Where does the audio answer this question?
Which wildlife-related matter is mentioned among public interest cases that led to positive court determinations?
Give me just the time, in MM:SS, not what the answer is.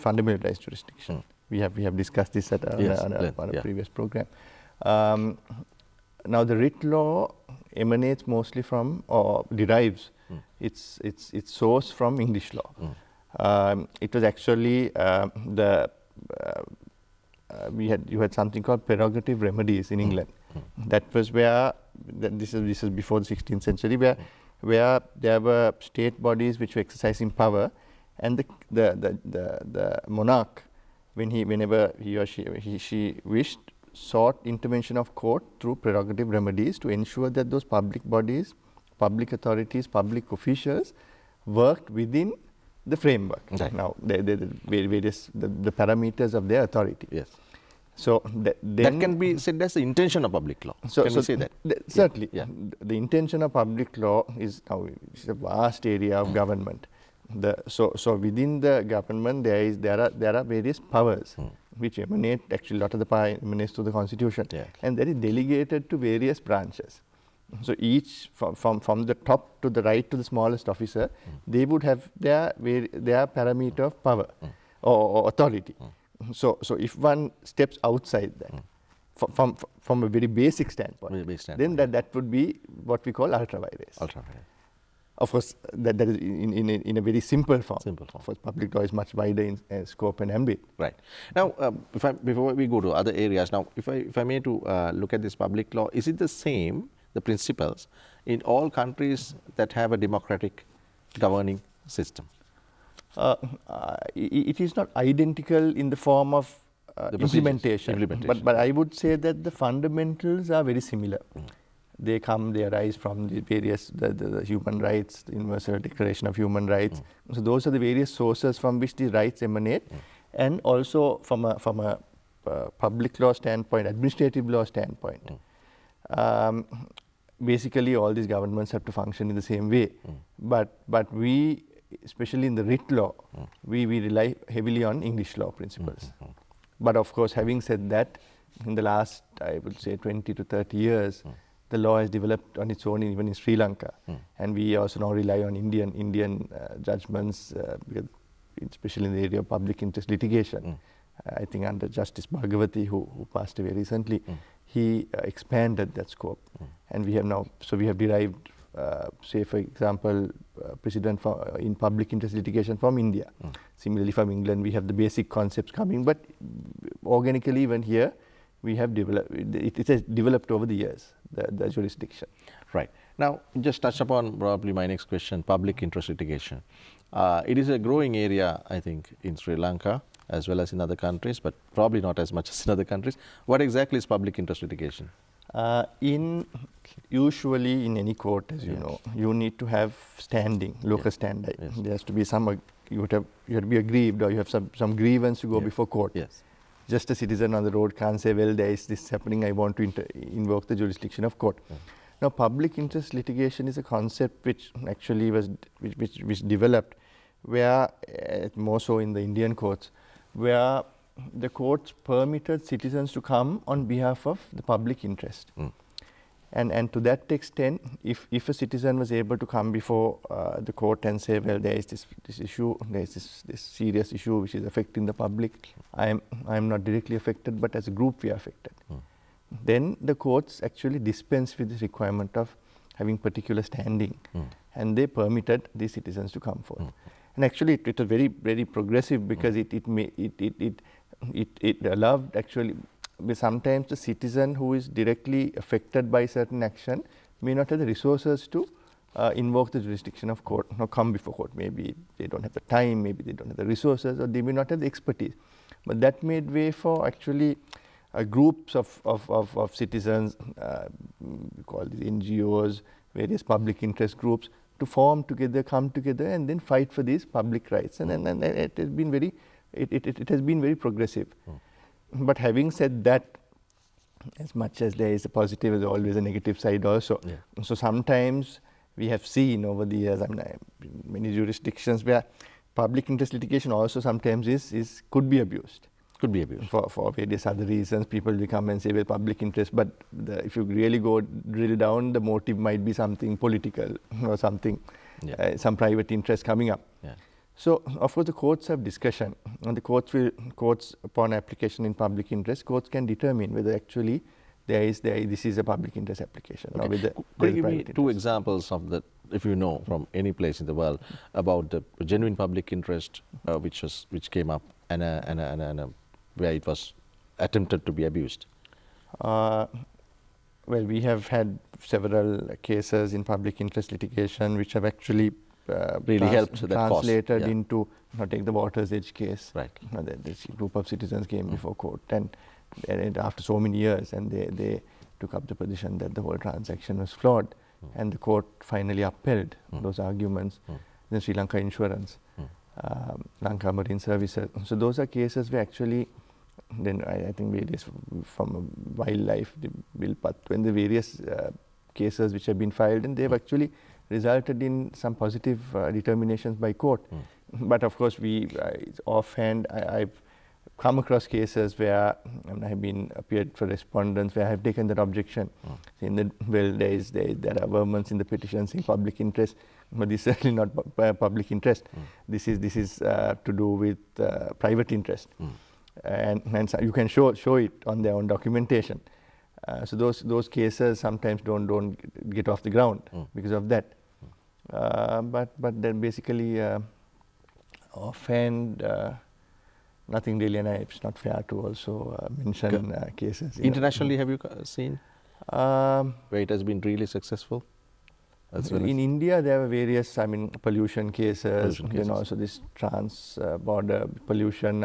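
05:49.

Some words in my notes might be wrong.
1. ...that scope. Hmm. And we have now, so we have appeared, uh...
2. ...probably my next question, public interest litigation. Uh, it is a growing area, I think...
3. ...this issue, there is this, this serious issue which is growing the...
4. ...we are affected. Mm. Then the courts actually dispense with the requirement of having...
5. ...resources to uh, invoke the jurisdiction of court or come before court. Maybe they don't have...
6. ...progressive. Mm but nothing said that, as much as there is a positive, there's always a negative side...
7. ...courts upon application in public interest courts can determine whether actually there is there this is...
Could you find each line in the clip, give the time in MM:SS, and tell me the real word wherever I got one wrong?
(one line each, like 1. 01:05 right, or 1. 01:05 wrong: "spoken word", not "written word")
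1. 02:35 wrong: "derived", not "appeared"
2. 02:54 right
3. 03:42 wrong: "affecting", not "growing"
4. 03:48 right
5. 04:07 right
6. 04:30 wrong: "having", not "nothing"
7. 05:00 right.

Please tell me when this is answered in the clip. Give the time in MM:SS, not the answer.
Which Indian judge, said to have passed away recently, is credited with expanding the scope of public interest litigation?
02:31.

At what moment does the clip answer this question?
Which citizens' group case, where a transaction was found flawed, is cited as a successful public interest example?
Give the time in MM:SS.
05:28.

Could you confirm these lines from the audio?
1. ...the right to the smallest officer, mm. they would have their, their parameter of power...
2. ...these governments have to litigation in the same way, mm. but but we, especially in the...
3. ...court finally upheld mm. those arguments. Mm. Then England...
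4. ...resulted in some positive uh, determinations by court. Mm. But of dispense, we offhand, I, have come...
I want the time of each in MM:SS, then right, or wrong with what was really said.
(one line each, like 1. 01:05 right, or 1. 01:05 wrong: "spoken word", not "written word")
1. 01:09 right
2. 02:08 wrong: "function", not "litigation"
3. 05:38 wrong: "Sri", not "England"
4. 05:54 wrong: "course", not "dispense".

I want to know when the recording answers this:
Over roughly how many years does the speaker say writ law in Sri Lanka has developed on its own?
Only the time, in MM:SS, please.
02:19.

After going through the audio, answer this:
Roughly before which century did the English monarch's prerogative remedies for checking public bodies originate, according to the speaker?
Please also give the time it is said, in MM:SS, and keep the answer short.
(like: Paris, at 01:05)
16th century, at 00:23.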